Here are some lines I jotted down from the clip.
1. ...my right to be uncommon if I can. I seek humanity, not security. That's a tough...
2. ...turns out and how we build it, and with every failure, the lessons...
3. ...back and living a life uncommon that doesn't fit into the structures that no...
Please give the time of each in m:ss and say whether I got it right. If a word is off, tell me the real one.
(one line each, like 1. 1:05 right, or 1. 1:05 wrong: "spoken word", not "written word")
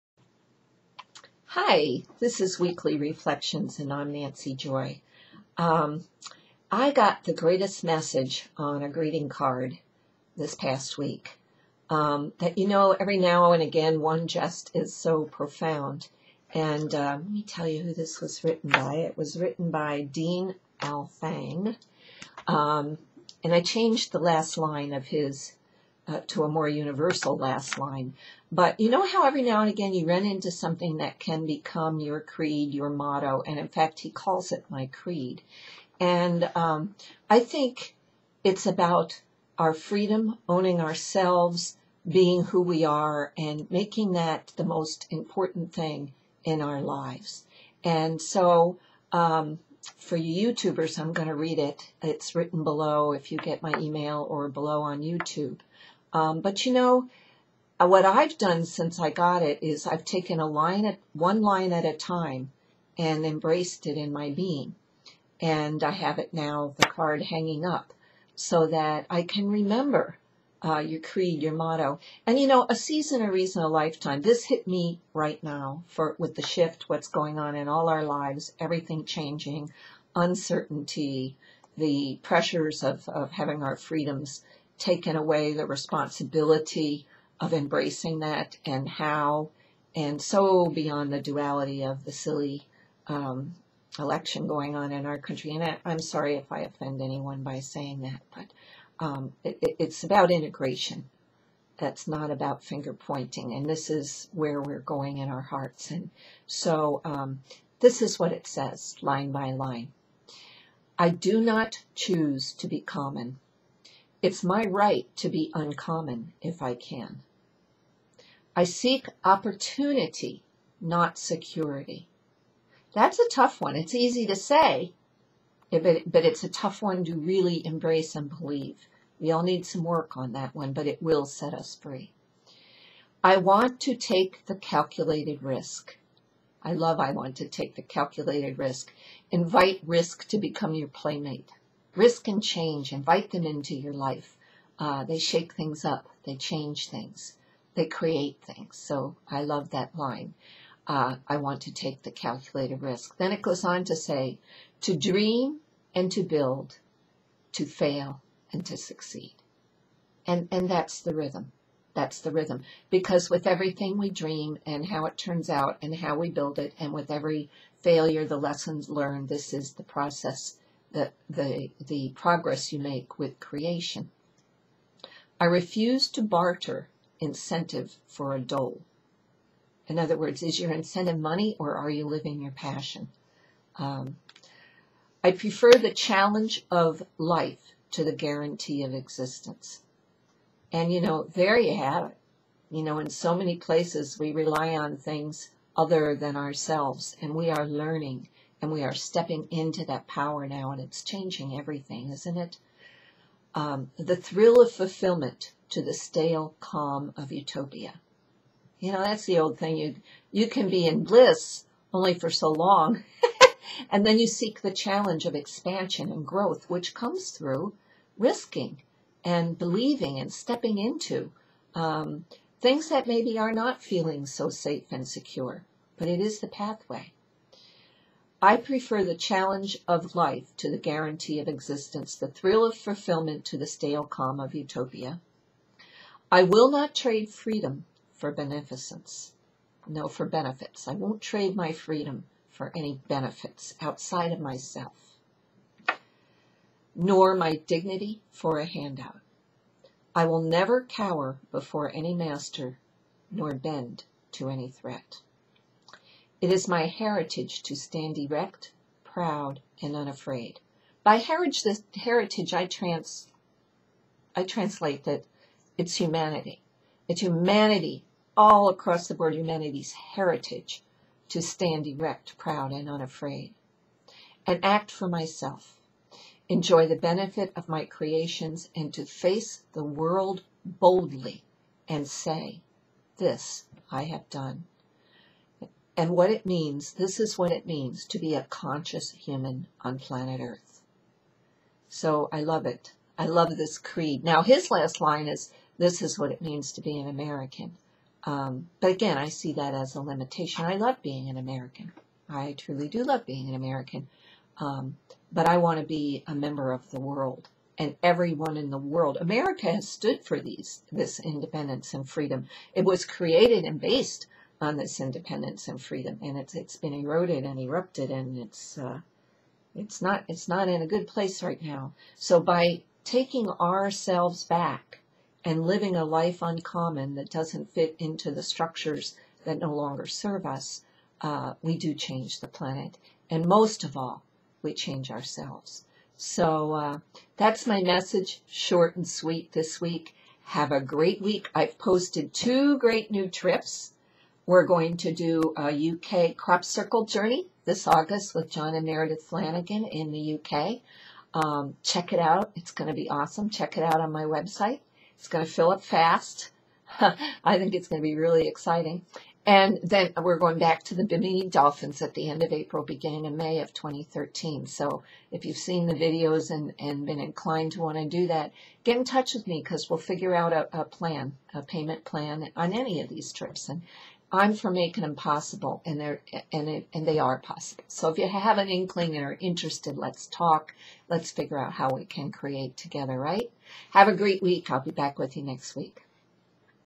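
1. 1:54 wrong: "opportunity", not "humanity"
2. 2:45 right
3. 5:24 right.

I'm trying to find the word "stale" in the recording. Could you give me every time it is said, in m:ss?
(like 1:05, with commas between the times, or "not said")
3:25, 3:53.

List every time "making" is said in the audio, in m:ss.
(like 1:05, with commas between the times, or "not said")
0:43, 6:14.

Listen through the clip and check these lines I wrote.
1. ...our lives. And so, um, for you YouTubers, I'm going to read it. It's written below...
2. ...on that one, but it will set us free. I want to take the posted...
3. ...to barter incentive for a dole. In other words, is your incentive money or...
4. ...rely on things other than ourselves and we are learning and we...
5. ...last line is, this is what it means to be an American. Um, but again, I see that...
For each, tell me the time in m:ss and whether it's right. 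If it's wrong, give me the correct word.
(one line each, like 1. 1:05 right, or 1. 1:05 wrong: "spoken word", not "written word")
1. 0:46 right
2. 2:10 wrong: "calculated", not "posted"
3. 2:56 right
4. 3:14 right
5. 4:54 right.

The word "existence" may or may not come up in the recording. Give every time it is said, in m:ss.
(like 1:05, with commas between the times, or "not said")
3:08, 3:51.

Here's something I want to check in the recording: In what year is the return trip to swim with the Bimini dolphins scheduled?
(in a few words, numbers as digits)
2013.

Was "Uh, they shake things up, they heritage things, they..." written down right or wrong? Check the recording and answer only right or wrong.
wrong.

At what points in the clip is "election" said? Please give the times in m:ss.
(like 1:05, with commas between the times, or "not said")
1:33.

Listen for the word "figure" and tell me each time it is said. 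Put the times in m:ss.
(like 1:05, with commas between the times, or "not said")
6:09, 6:21.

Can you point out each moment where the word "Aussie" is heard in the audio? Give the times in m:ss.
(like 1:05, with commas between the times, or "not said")
not said.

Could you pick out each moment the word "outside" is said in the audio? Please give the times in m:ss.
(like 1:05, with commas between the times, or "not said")
4:03.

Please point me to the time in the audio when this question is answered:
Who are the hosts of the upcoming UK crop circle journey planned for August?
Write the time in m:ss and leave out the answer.
5:48.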